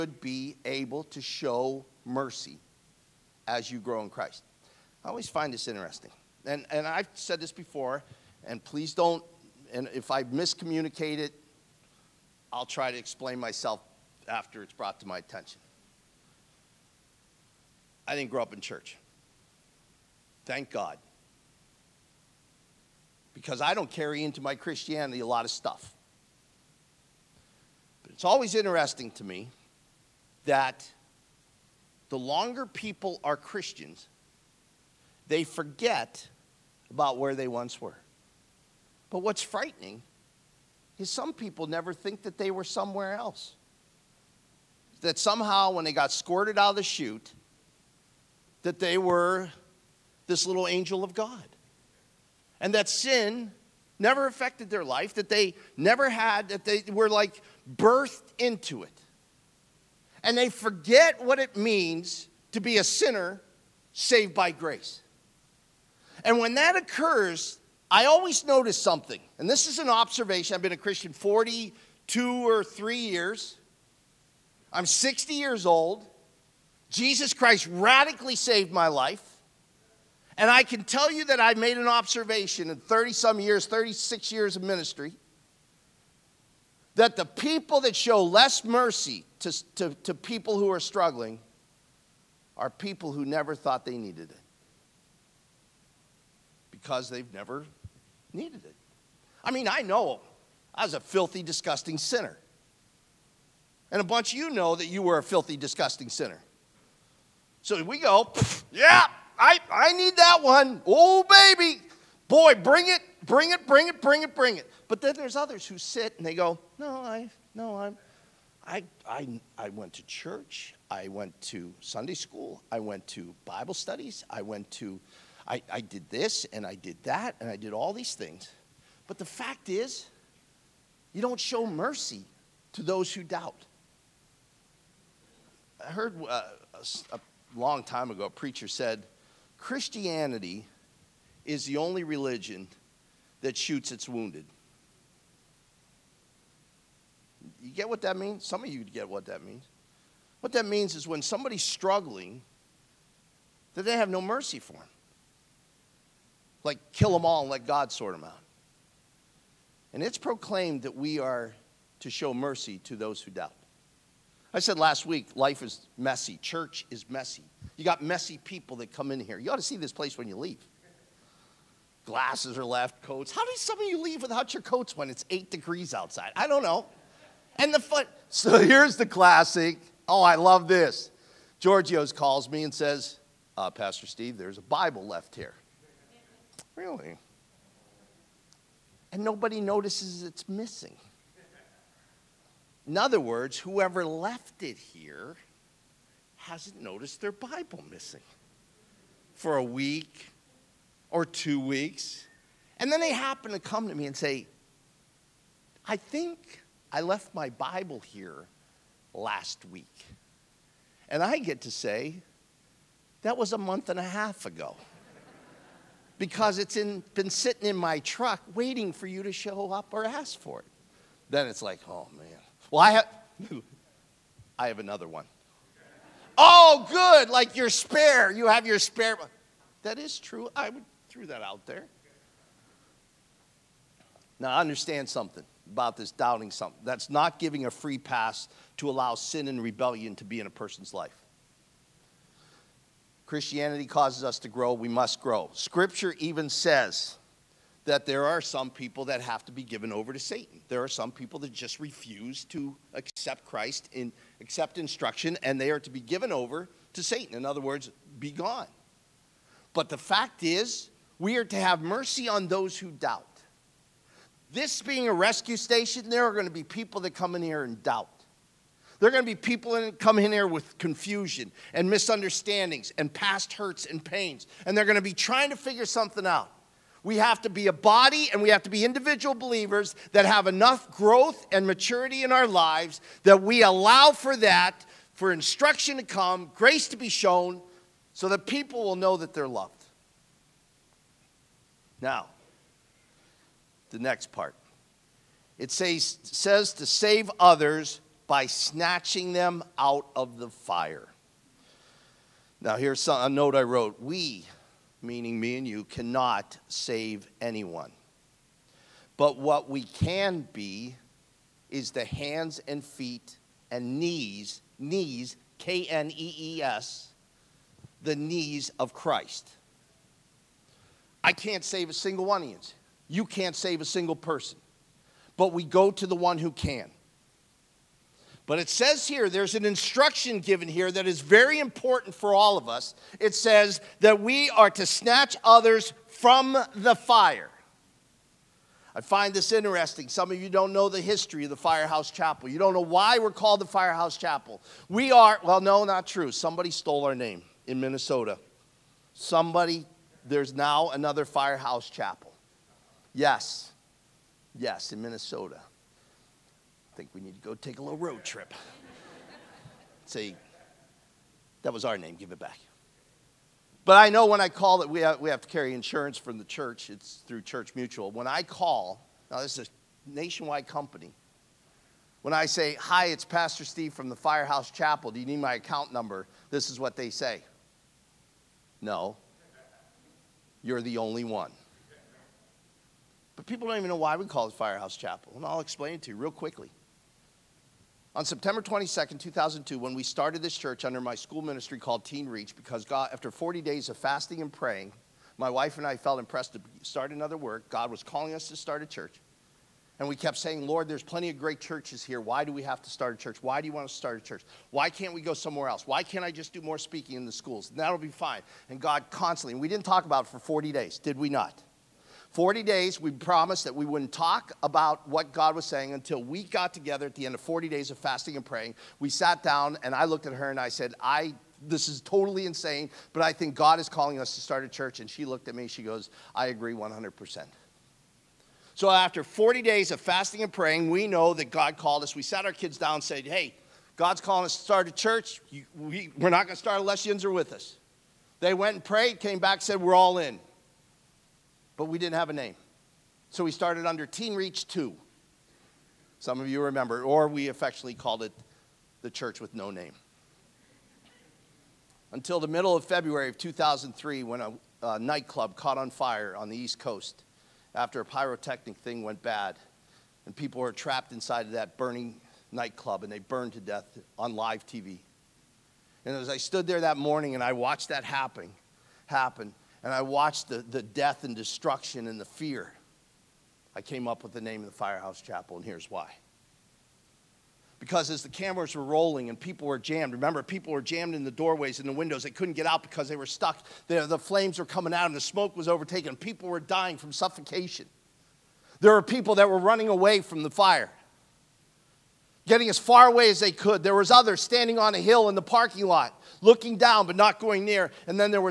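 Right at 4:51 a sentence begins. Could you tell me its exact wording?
Now, the next part it says, says to save others by snatching them out of the fire.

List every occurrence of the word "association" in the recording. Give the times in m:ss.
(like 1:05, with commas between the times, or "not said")
not said.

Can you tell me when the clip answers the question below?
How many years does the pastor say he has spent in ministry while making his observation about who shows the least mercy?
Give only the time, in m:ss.
1:23.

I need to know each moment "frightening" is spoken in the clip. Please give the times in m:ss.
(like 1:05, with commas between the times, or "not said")
0:39.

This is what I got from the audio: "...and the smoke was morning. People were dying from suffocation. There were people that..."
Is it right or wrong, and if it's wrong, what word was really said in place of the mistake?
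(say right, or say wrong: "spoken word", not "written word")
wrong: "overtaking", not "morning".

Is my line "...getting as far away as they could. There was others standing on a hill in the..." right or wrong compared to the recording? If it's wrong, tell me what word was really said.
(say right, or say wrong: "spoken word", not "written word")
right.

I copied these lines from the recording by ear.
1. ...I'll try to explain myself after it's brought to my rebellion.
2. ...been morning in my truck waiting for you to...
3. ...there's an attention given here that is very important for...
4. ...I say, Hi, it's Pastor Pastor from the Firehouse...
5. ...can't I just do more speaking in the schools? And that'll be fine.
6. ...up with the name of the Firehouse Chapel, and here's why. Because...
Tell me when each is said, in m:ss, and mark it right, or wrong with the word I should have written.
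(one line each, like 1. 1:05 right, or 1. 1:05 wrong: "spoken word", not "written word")
1. 0:12 wrong: "attention", not "rebellion"
2. 3:37 wrong: "sitting", not "morning"
3. 5:29 wrong: "instruction", not "attention"
4. 6:12 wrong: "Steve", not "Pastor"
5. 6:46 right
6. 7:54 right.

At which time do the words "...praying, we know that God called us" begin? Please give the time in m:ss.
7:10.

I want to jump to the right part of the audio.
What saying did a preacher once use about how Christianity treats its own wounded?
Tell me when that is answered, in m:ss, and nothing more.
2:23.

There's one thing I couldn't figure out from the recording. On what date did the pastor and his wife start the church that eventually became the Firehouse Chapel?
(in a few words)
September 22, 2002.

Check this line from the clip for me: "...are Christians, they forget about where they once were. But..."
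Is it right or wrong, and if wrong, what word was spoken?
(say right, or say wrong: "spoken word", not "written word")
right.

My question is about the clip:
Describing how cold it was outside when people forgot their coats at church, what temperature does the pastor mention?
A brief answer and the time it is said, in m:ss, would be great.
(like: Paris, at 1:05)
8 degrees, at 2:55.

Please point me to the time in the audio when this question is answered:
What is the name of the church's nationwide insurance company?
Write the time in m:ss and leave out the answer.
6:07.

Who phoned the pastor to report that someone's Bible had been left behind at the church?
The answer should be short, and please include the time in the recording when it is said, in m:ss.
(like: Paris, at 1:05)
Georgios, at 3:01.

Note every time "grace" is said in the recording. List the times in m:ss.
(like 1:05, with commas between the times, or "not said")
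1:04, 4:46.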